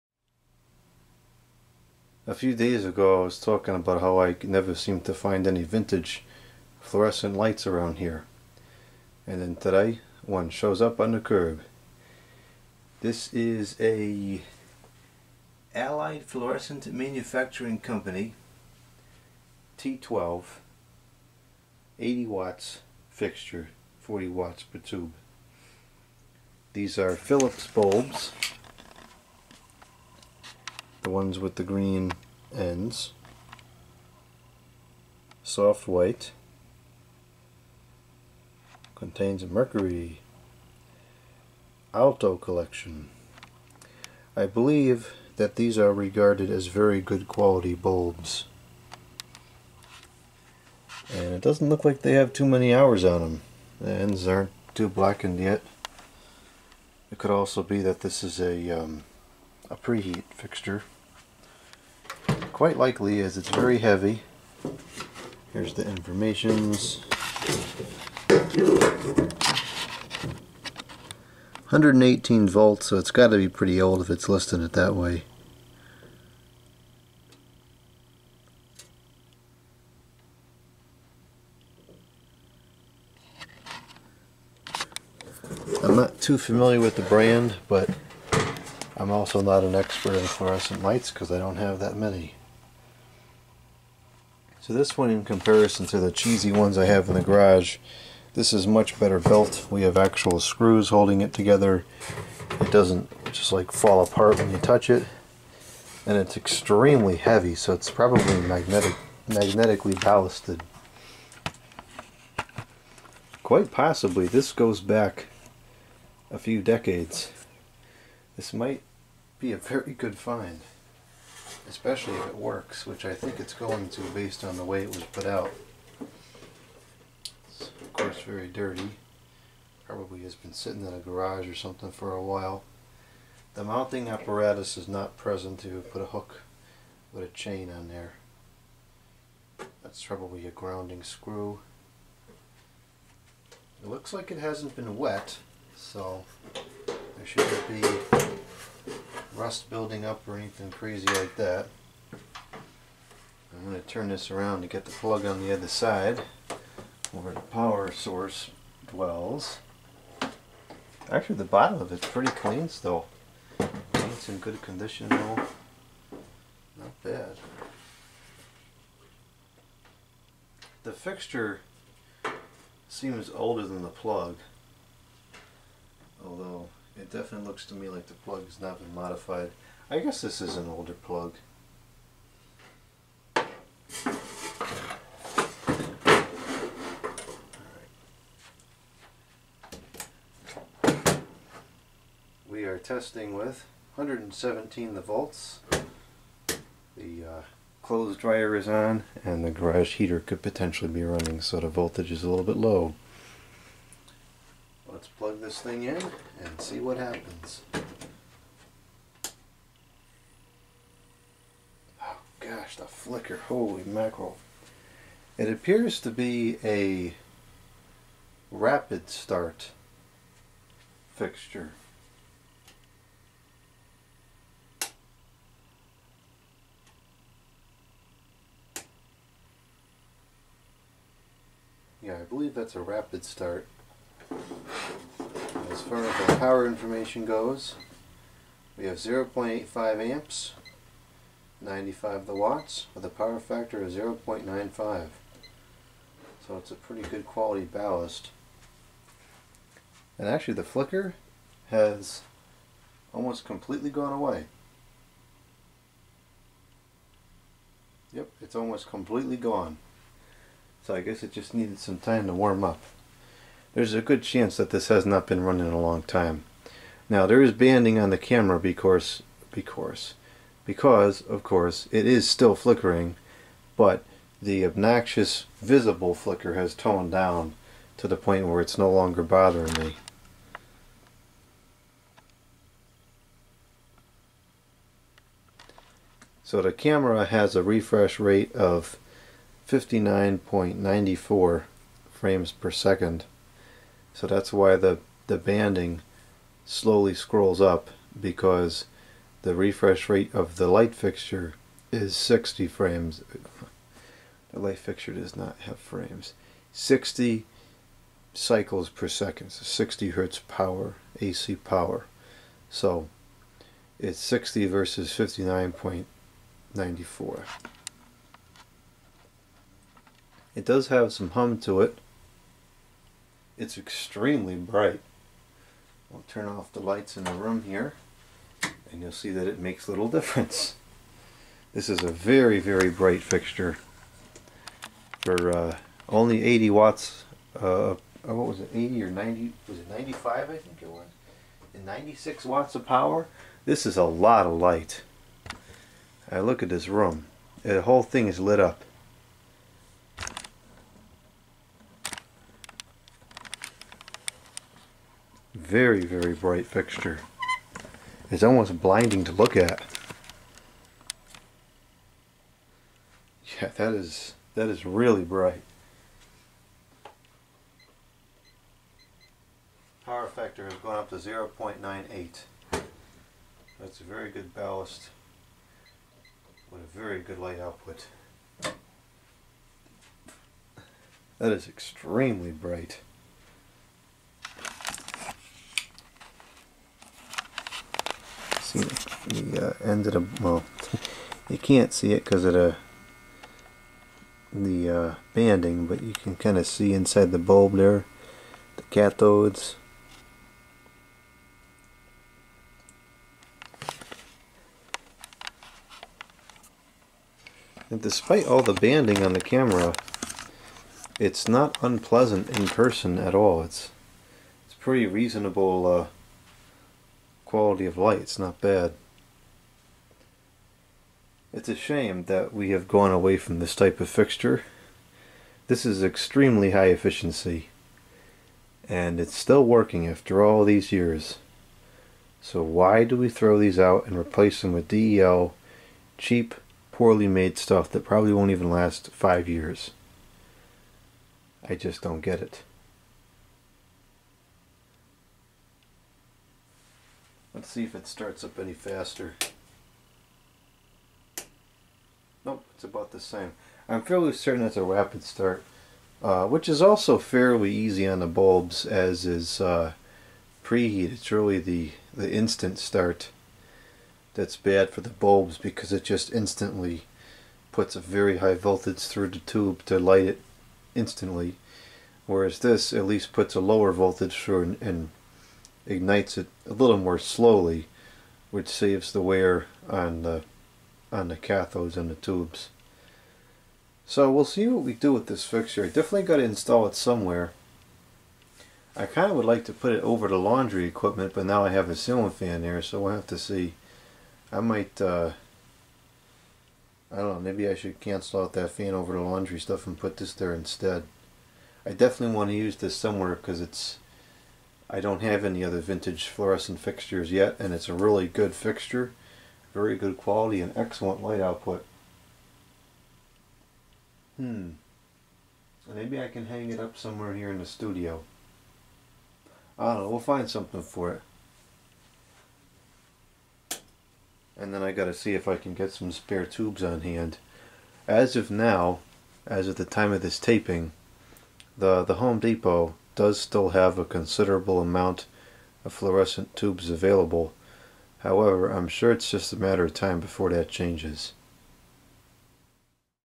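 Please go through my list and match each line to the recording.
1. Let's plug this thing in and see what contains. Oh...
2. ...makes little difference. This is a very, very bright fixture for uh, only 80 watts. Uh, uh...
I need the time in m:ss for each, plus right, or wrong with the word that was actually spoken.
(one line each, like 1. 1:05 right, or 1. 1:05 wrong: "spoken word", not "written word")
1. 3:25 wrong: "happens", not "contains"
2. 5:29 right.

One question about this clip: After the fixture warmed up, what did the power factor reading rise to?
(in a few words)
0.98.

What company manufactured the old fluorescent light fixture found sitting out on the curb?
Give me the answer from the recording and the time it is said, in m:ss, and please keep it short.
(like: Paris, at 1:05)
Allied Fluorescent Manufacturing Company, at 0:15.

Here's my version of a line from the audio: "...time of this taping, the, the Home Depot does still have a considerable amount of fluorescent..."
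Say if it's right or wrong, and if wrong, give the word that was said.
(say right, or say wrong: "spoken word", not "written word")
right.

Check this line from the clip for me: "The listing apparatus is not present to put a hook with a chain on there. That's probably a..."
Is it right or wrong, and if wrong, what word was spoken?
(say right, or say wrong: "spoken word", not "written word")
wrong: "mounting", not "listing".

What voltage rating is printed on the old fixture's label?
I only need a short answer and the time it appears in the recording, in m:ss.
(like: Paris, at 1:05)
118 volts, at 1:08.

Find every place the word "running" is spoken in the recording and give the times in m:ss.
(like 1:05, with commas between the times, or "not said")
3:21, 4:25.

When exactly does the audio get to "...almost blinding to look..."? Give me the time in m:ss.
5:58.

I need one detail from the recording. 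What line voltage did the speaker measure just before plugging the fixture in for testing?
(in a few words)
117 volts.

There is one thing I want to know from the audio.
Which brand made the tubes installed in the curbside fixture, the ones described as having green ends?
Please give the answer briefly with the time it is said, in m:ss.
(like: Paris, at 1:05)
Philips, at 0:27.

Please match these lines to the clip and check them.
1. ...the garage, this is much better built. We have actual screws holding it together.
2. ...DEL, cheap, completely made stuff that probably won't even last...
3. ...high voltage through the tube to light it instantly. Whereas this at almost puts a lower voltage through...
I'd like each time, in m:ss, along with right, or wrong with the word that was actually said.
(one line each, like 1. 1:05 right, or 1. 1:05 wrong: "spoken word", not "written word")
1. 1:37 right
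2. 7:14 wrong: "poorly", not "completely"
3. 7:48 wrong: "least", not "almost".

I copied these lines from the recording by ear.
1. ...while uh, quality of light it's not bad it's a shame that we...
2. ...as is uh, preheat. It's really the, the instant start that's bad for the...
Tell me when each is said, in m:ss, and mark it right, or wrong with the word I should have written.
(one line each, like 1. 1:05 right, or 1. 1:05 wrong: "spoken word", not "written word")
1. 6:55 wrong: "reasonable", not "while"
2. 7:38 right.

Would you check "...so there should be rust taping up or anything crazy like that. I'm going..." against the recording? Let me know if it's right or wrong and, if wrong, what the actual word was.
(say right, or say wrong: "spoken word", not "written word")
wrong: "building", not "taping".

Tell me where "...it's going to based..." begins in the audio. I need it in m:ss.
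2:03.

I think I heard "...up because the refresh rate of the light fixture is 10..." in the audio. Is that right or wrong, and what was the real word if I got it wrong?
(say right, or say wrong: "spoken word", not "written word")
wrong: "60", not "10".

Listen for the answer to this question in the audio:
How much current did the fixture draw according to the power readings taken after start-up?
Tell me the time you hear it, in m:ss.
3:58.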